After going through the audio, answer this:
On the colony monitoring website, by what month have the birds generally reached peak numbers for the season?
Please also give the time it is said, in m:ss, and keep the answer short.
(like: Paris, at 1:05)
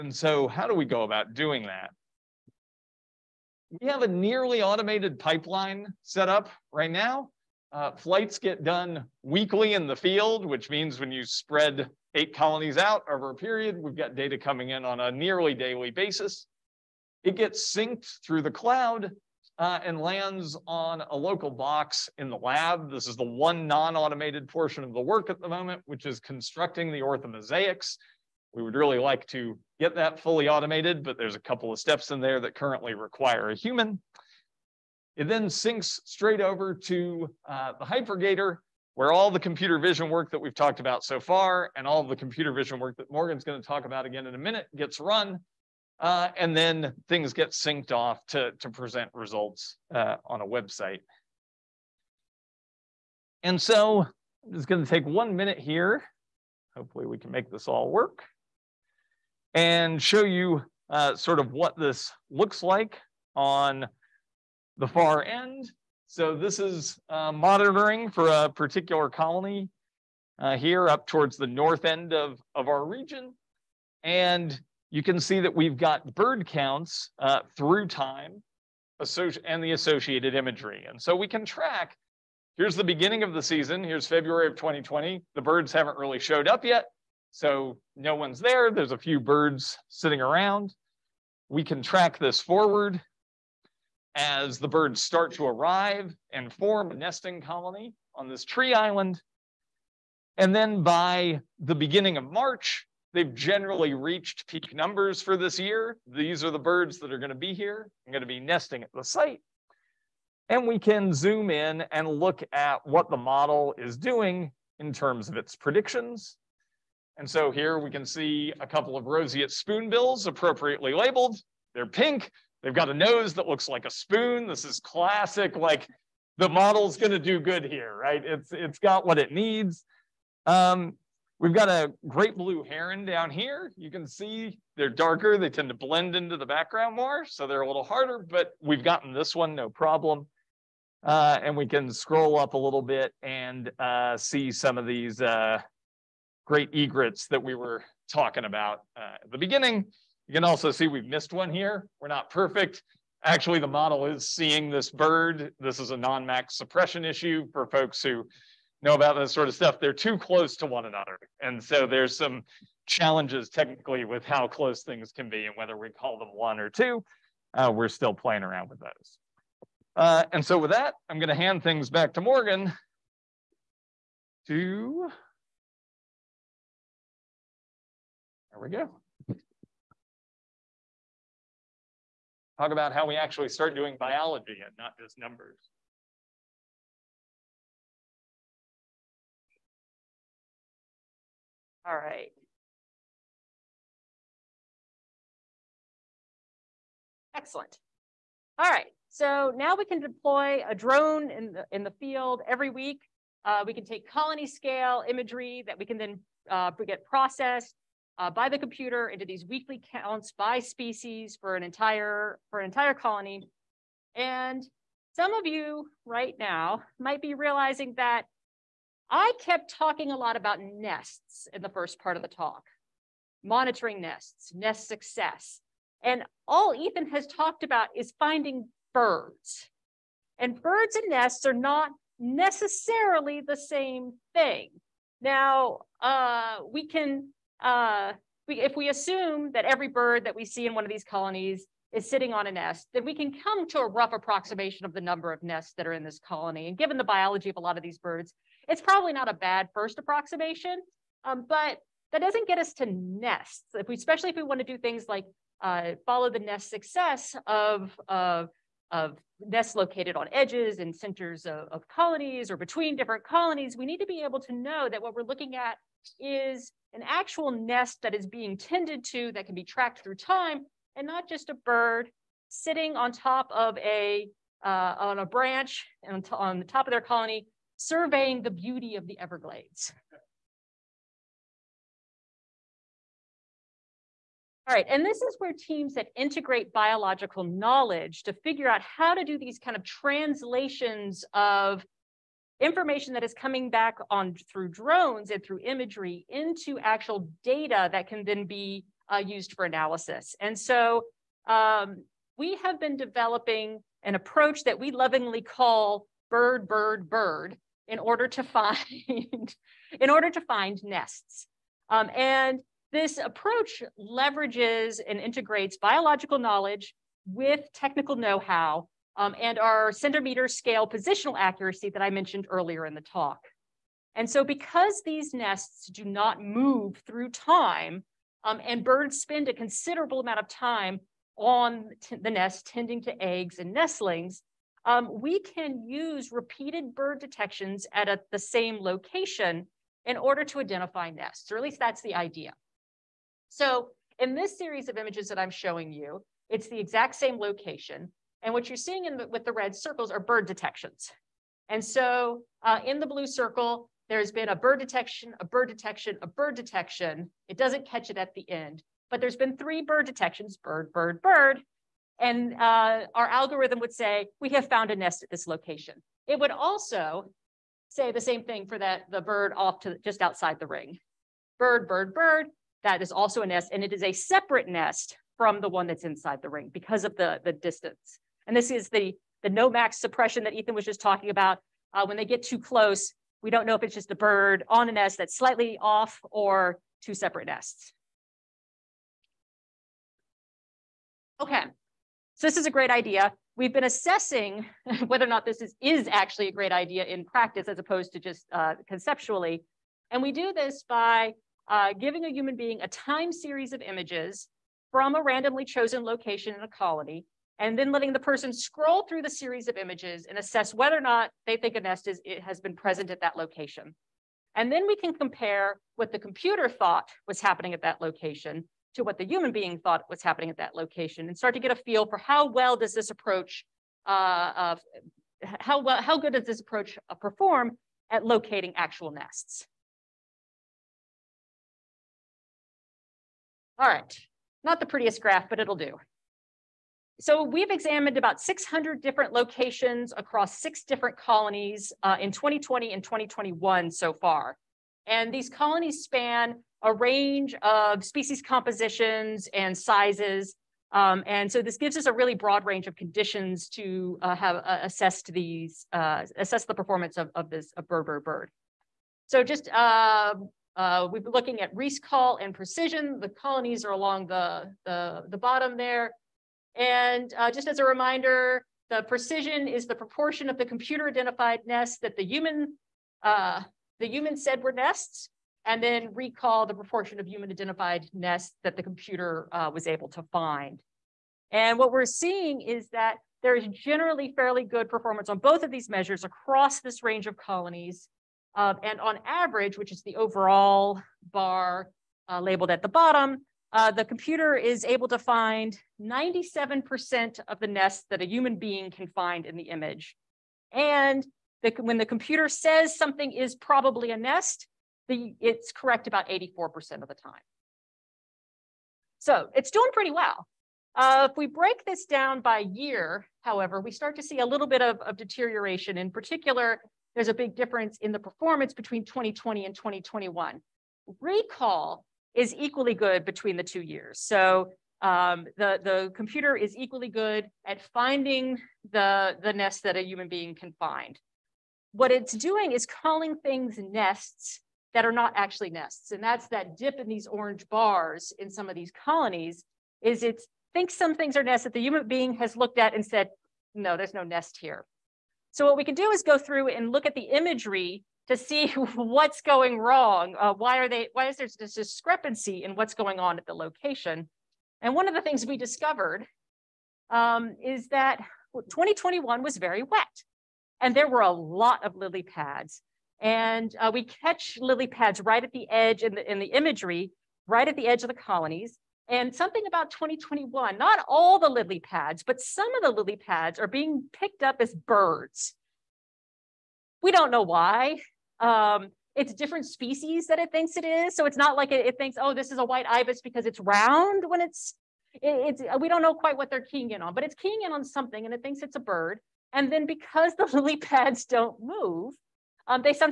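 March, at 1:42.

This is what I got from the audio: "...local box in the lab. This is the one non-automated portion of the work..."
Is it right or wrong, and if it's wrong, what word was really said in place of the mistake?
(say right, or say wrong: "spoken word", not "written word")
right.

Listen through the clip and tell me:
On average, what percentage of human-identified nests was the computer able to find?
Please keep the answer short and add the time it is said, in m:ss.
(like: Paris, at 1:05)
97%, at 8:16.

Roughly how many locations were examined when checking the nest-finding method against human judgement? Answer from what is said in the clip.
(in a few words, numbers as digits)
600.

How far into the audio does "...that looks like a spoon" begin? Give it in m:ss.
2:03.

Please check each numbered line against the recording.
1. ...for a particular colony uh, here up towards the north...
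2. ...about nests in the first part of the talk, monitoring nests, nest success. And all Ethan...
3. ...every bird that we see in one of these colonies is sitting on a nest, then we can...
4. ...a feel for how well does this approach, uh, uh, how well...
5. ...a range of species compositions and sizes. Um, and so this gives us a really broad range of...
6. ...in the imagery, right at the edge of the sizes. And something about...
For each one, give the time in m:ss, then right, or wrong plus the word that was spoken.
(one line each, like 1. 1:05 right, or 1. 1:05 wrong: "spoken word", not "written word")
1. 1:08 right
2. 3:40 right
3. 3:59 right
4. 7:01 right
5. 7:26 right
6. 9:26 wrong: "colonies", not "sizes".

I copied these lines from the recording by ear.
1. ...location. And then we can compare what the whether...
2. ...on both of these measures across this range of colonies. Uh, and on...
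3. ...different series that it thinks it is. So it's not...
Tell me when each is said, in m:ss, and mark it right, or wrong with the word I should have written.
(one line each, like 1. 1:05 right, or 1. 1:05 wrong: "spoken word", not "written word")
1. 6:53 wrong: "computer", not "whether"
2. 8:05 right
3. 9:39 wrong: "species", not "series".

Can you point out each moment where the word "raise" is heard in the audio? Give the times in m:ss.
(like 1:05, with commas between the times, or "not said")
not said.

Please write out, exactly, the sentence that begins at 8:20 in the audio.
And the, when the computer says something is probably a nest, the, it's correct about 84% of the time.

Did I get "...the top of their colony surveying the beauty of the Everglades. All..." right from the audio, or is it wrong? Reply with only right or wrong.
right.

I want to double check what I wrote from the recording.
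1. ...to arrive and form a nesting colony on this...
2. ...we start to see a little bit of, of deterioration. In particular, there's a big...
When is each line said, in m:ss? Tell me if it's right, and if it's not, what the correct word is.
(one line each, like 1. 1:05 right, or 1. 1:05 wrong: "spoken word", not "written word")
1. 1:35 right
2. 8:33 right.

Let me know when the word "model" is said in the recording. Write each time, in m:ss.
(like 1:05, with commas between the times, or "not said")
1:53, 2:06, 2:33.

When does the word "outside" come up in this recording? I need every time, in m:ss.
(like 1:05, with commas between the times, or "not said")
6:10.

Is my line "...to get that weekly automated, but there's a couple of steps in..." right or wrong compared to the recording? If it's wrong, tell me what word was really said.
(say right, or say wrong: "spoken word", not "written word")
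wrong: "fully", not "weekly".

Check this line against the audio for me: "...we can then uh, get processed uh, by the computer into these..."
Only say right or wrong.
right.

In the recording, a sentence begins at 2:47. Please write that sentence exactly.
Uh, we're still playing around with those.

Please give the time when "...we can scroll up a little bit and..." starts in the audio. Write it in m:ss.
2:21.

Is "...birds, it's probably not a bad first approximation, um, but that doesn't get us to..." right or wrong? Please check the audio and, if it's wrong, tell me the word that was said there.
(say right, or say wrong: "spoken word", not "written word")
right.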